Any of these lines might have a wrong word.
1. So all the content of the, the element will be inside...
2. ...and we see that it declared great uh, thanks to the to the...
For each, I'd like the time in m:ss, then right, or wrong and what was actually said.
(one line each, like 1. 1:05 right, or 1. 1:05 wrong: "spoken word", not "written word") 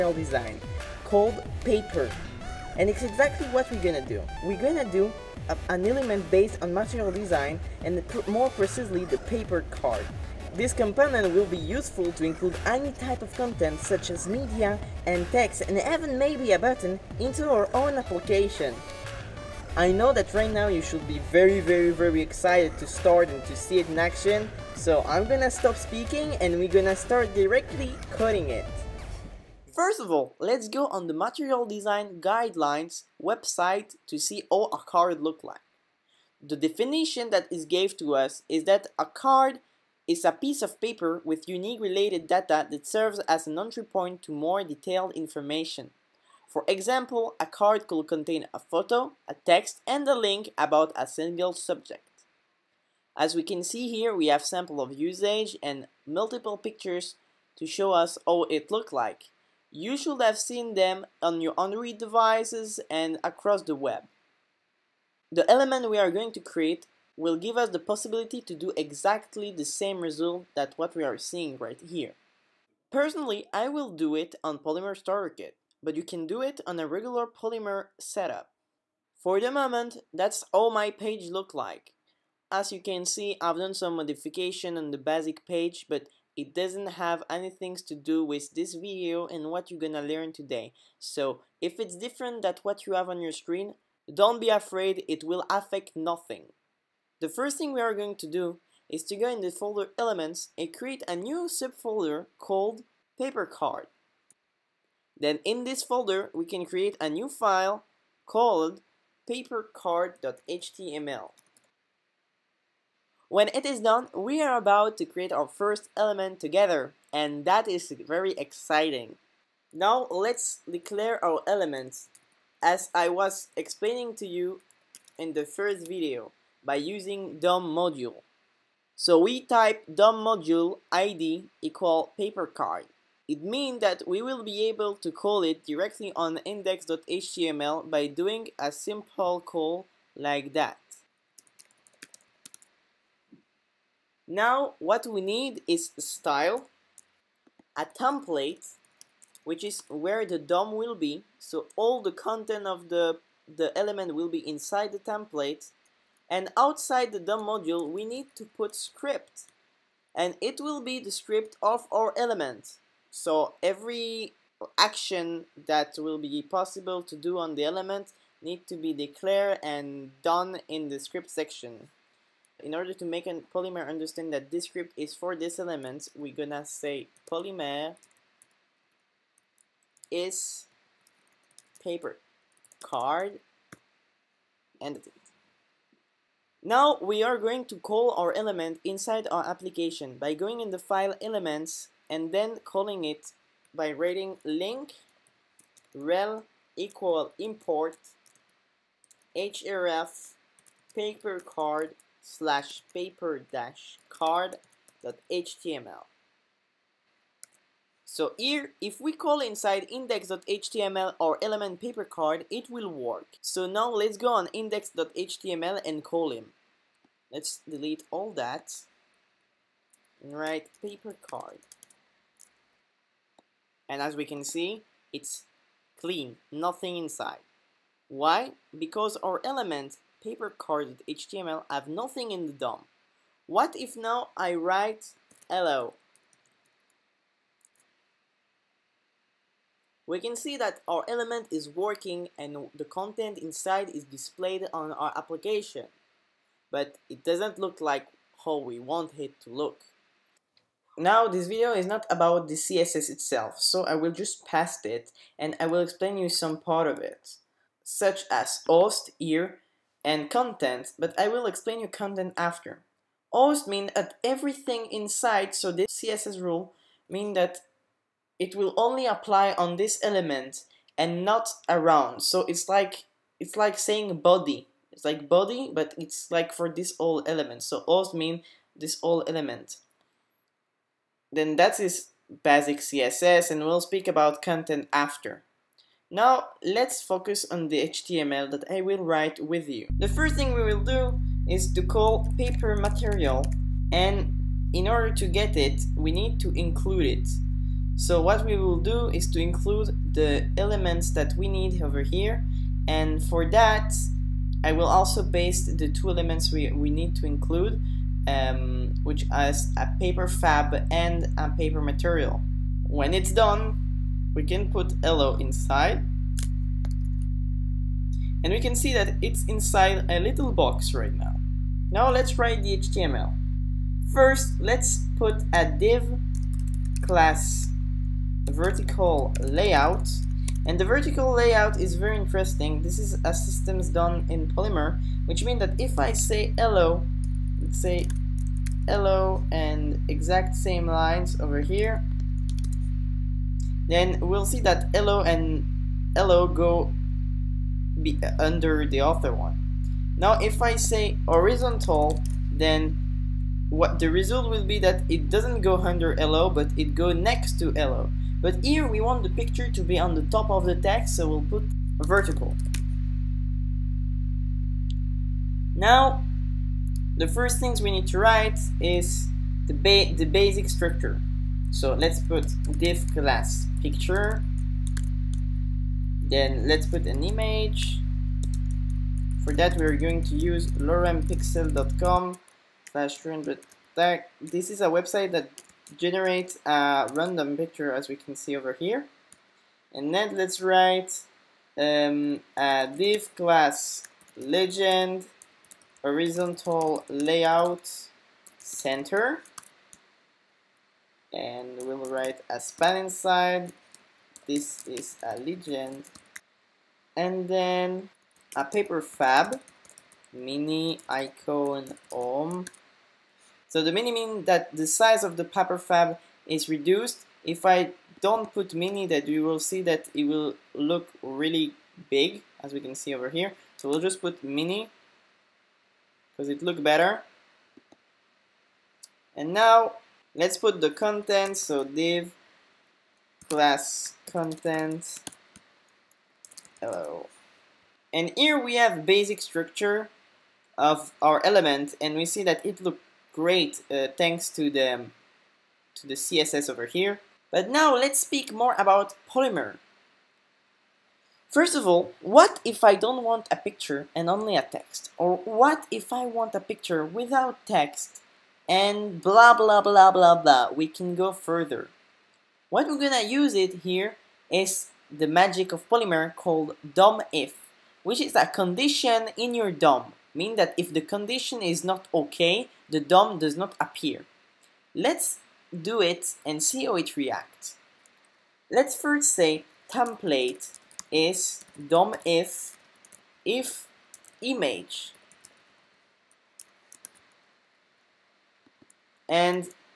1. 2:31 right
2. 7:21 wrong: "looked", not "declared".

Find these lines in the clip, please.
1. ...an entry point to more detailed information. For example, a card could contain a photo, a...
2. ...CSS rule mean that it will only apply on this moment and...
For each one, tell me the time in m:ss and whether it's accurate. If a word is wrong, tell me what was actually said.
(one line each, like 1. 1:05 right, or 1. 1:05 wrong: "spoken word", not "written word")
1. 0:43 right
2. 4:26 wrong: "element", not "moment".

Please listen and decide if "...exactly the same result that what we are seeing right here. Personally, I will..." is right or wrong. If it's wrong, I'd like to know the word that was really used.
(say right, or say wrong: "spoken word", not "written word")
right.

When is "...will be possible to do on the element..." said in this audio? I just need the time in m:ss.
2:45.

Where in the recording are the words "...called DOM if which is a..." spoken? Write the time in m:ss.
7:46.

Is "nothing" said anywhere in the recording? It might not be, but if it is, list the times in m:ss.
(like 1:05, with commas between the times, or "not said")
1:35, 3:46, 3:51.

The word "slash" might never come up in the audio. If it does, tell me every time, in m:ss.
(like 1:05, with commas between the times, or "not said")
3:22, 6:22.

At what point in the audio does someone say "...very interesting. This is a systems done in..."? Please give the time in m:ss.
5:31.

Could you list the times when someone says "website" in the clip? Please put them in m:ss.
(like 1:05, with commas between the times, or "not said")
0:33, 6:24.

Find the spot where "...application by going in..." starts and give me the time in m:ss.
3:09.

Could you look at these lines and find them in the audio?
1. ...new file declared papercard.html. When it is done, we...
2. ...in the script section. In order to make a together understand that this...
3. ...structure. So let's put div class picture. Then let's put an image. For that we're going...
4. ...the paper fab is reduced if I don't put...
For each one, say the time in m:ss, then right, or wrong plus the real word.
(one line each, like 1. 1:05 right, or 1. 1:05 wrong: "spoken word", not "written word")
1. 1:47 wrong: "called", not "declared"
2. 2:50 wrong: "polymer", not "together"
3. 6:10 right
4. 6:55 right.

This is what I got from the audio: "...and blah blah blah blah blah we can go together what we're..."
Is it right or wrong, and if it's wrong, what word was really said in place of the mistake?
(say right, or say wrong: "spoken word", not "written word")
wrong: "further", not "together".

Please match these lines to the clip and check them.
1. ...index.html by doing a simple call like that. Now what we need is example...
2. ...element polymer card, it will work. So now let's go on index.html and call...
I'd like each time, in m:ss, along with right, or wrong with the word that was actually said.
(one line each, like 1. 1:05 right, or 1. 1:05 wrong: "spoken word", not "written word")
1. 2:16 wrong: "style", not "example"
2. 3:31 wrong: "paper", not "polymer".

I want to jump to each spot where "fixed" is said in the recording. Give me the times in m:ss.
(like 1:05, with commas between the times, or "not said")
not said.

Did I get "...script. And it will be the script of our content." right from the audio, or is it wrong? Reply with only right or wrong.
wrong.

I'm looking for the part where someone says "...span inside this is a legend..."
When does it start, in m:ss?
6:42.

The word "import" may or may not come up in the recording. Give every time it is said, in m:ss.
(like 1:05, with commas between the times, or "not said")
3:17.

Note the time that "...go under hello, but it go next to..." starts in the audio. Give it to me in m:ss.
5:55.